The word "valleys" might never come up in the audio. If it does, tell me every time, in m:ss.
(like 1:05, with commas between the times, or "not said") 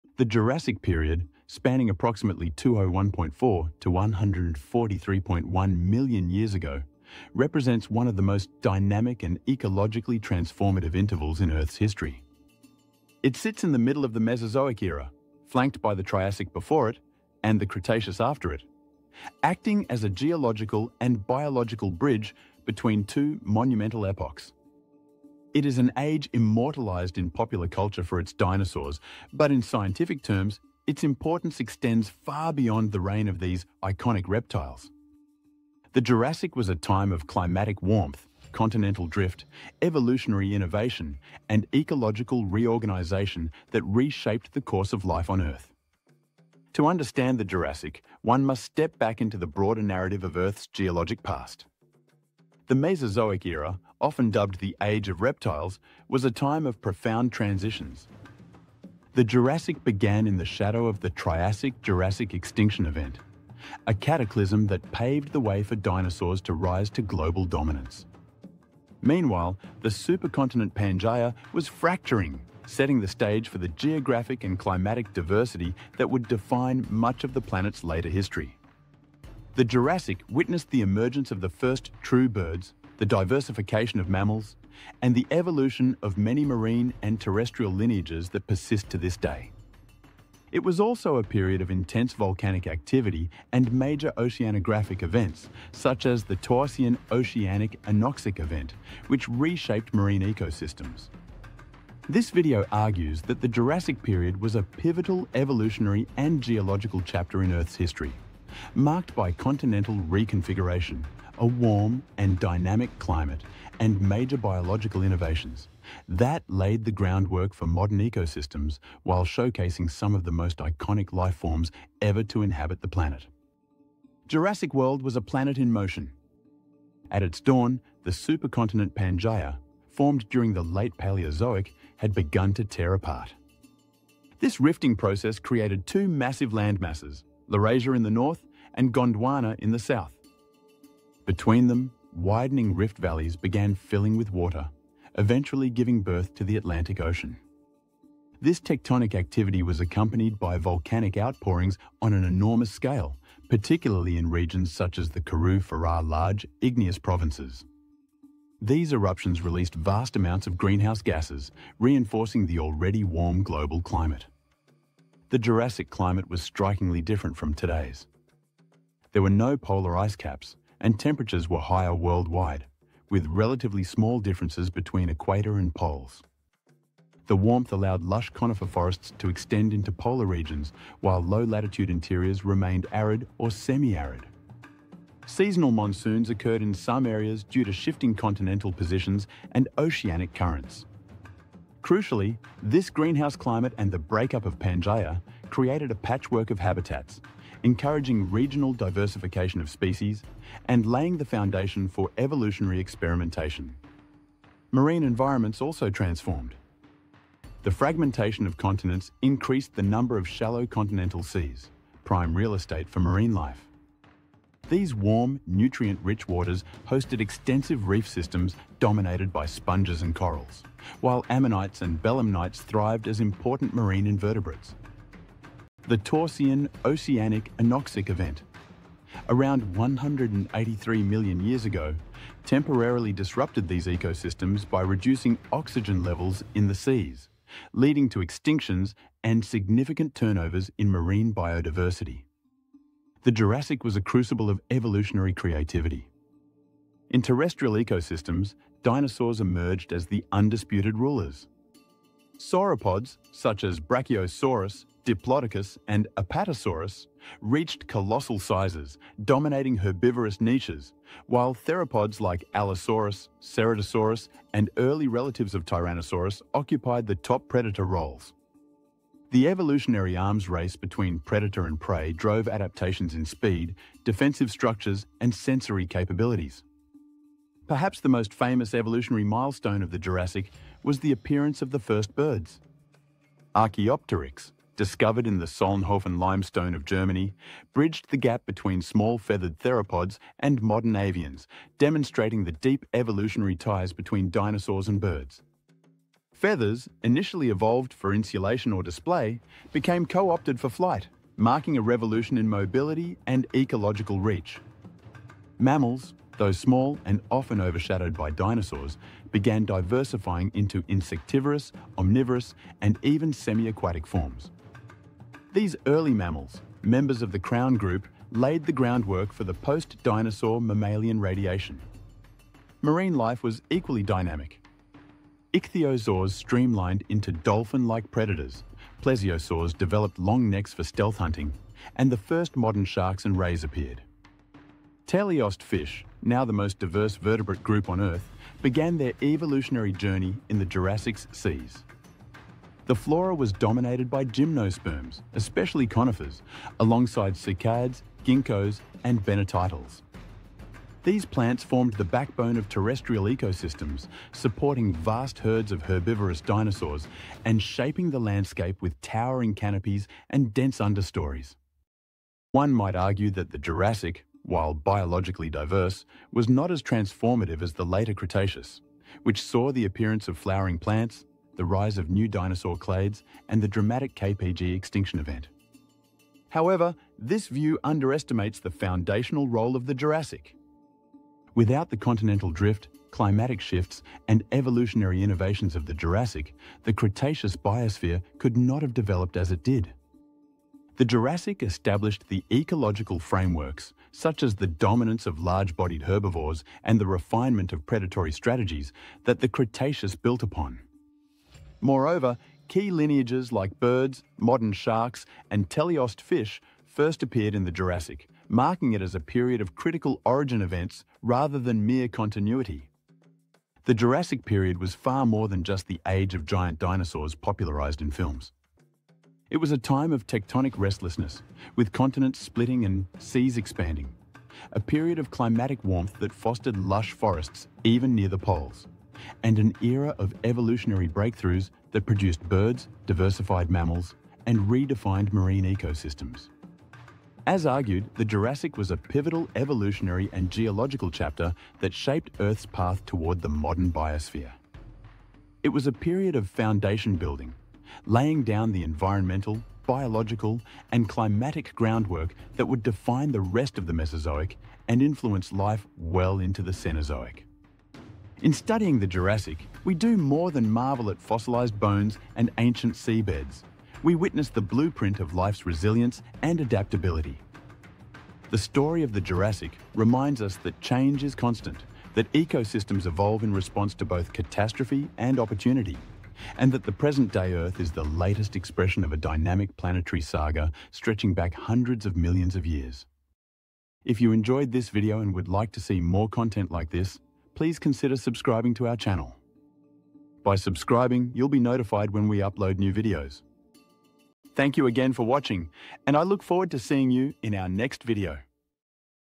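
2:22.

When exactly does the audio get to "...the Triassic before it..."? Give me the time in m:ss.
0:15.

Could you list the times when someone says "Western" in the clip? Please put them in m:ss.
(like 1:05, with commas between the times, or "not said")
not said.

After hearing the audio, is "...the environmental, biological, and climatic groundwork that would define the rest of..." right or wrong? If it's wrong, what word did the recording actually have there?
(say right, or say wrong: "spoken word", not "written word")
right.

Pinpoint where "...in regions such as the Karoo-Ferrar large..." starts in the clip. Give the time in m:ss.
2:34.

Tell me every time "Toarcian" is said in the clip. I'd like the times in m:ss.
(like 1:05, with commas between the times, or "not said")
1:36, 3:45.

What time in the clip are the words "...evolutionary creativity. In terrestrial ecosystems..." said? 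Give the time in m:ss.
4:04.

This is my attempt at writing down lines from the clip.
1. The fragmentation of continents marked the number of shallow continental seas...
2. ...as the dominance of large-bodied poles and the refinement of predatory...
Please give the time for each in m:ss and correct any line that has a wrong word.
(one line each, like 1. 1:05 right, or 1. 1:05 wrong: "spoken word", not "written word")
1. 3:27 wrong: "increased", not "marked"
2. 6:34 wrong: "herbivores", not "poles".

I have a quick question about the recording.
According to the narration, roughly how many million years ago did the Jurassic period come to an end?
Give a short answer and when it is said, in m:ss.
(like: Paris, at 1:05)
143.1, at 0:03.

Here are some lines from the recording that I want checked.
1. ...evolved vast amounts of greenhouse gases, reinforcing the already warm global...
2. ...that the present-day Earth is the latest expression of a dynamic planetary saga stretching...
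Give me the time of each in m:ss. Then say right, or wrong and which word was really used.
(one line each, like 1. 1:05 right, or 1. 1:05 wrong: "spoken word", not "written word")
1. 2:39 wrong: "released", not "evolved"
2. 7:56 right.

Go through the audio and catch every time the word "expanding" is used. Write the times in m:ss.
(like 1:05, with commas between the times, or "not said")
7:03.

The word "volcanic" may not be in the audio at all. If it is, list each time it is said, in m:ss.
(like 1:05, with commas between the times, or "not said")
1:32, 2:30.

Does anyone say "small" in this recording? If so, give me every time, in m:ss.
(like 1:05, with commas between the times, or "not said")
2:53, 4:48, 5:06.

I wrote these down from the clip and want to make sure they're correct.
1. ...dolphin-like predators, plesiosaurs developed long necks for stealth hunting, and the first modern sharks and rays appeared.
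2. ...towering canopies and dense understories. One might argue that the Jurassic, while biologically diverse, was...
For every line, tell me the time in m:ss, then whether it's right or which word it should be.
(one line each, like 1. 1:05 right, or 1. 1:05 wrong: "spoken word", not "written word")
1. 5:27 right
2. 5:59 right.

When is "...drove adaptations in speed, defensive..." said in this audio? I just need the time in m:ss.
4:32.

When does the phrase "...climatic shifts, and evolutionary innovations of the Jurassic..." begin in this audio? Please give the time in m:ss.
6:23.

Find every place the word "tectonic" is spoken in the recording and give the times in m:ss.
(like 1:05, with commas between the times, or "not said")
2:28, 7:00.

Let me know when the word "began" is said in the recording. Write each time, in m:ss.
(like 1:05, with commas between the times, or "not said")
0:59, 2:23, 5:09, 5:38.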